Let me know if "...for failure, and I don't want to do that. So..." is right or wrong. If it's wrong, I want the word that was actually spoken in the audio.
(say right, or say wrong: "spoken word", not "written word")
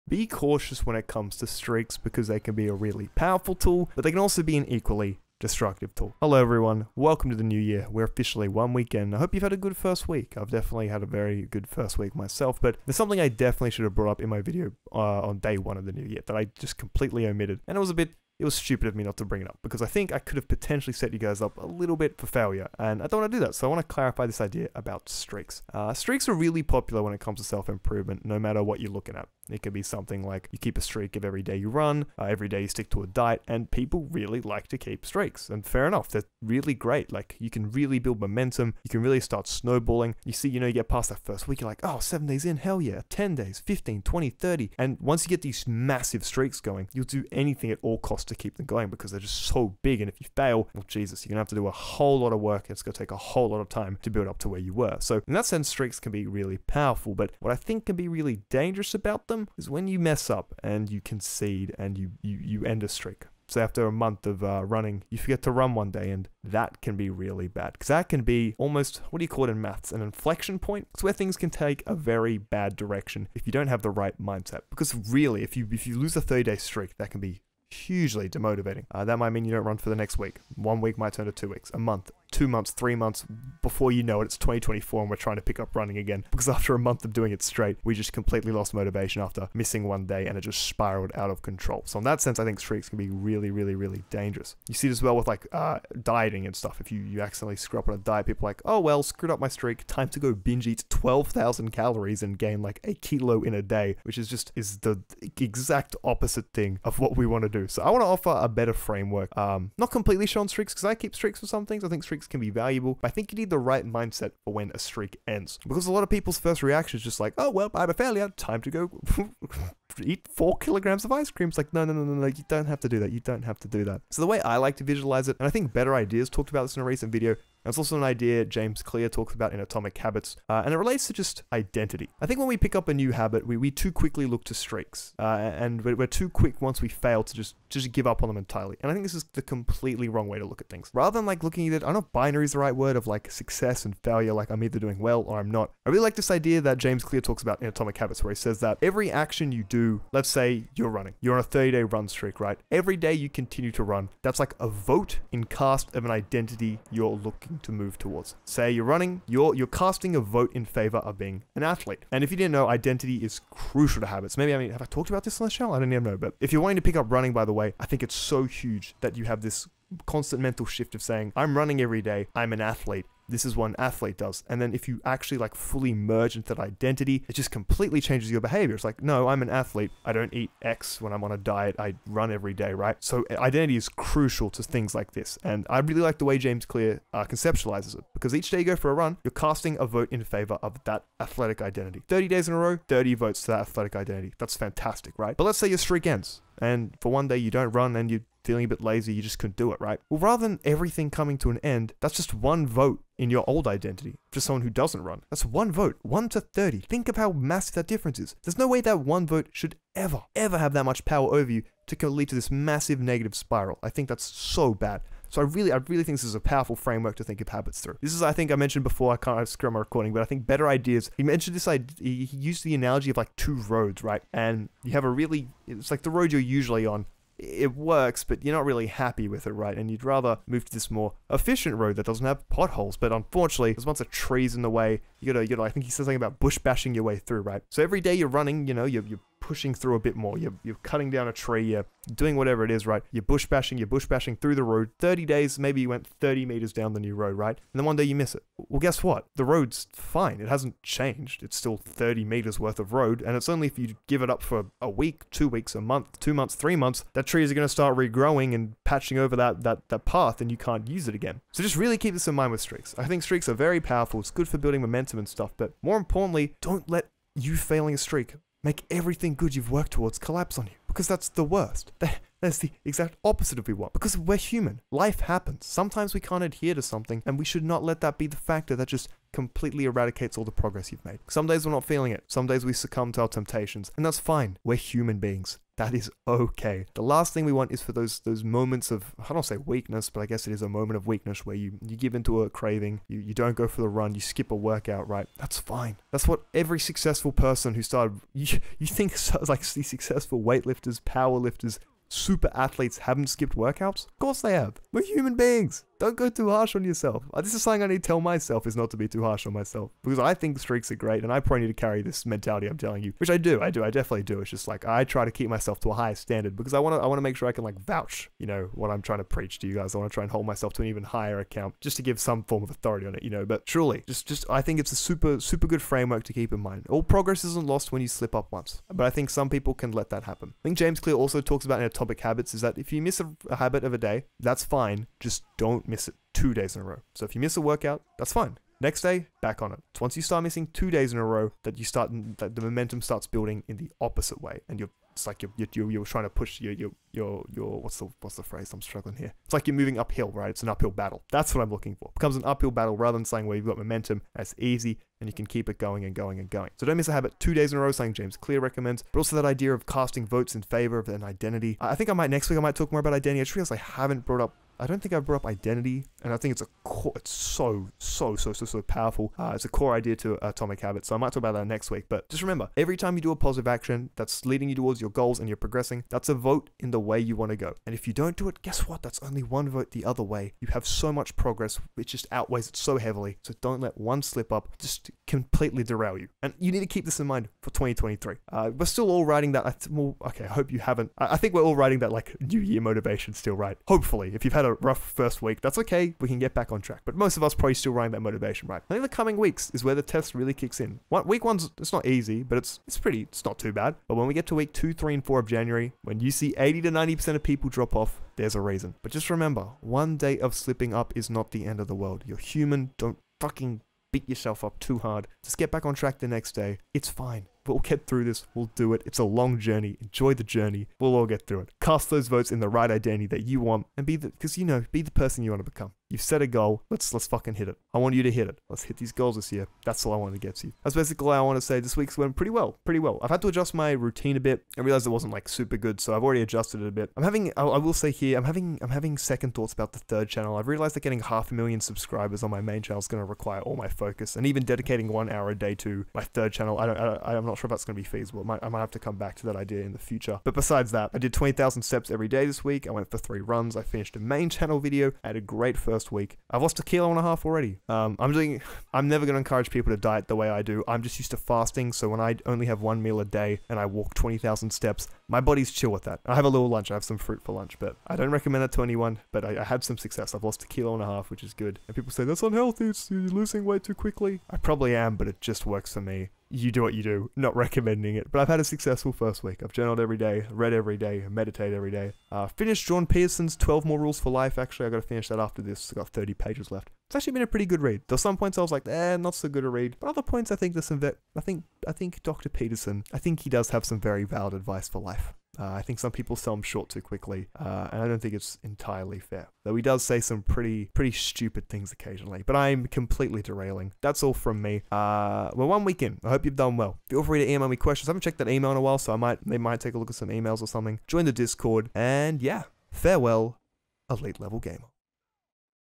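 right.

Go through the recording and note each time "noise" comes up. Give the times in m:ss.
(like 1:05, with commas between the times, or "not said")
not said.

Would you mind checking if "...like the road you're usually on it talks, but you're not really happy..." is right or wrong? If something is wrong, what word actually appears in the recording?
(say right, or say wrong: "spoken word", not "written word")
wrong: "works", not "talks".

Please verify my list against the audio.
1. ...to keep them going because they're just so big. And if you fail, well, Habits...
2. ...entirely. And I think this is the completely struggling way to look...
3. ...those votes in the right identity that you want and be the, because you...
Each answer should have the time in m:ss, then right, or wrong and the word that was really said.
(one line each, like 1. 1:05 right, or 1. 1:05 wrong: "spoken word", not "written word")
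1. 0:48 wrong: "Jesus", not "Habits"
2. 2:18 wrong: "wrong", not "struggling"
3. 7:02 right.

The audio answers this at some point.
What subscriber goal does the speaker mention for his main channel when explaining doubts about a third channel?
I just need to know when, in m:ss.
7:21.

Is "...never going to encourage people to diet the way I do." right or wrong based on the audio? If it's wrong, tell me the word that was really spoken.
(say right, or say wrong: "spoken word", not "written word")
right.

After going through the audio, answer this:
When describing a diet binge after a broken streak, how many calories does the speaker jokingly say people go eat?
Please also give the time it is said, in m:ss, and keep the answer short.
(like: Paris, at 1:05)
12,000, at 1:40.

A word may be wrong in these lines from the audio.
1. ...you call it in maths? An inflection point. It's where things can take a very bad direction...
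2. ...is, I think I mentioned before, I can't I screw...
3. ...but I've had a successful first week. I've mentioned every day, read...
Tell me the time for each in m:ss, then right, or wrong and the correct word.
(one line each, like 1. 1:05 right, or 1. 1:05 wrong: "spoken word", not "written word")
1. 1:09 right
2. 3:38 right
3. 7:58 wrong: "journaled", not "mentioned".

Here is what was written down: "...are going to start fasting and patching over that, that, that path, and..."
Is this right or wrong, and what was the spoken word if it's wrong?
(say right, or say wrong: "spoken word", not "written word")
wrong: "regrowing", not "fasting".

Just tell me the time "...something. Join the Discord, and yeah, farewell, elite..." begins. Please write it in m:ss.
8:30.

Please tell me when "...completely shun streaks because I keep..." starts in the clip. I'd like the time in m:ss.
1:49.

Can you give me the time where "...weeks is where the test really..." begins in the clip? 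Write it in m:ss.
6:39.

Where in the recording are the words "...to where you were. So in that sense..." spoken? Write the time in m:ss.
0:54.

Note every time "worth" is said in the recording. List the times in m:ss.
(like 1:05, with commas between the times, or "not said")
4:12.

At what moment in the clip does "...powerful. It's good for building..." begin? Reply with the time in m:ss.
4:23.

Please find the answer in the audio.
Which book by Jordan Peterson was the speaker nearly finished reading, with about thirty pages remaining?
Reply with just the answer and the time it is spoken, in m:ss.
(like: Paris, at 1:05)
12 More Rules for Life, at 8:03.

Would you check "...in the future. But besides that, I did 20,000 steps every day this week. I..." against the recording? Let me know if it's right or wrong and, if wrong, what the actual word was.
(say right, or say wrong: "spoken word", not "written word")
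right.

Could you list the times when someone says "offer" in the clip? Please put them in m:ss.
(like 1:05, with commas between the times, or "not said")
1:48.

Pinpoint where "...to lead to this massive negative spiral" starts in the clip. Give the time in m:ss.
3:31.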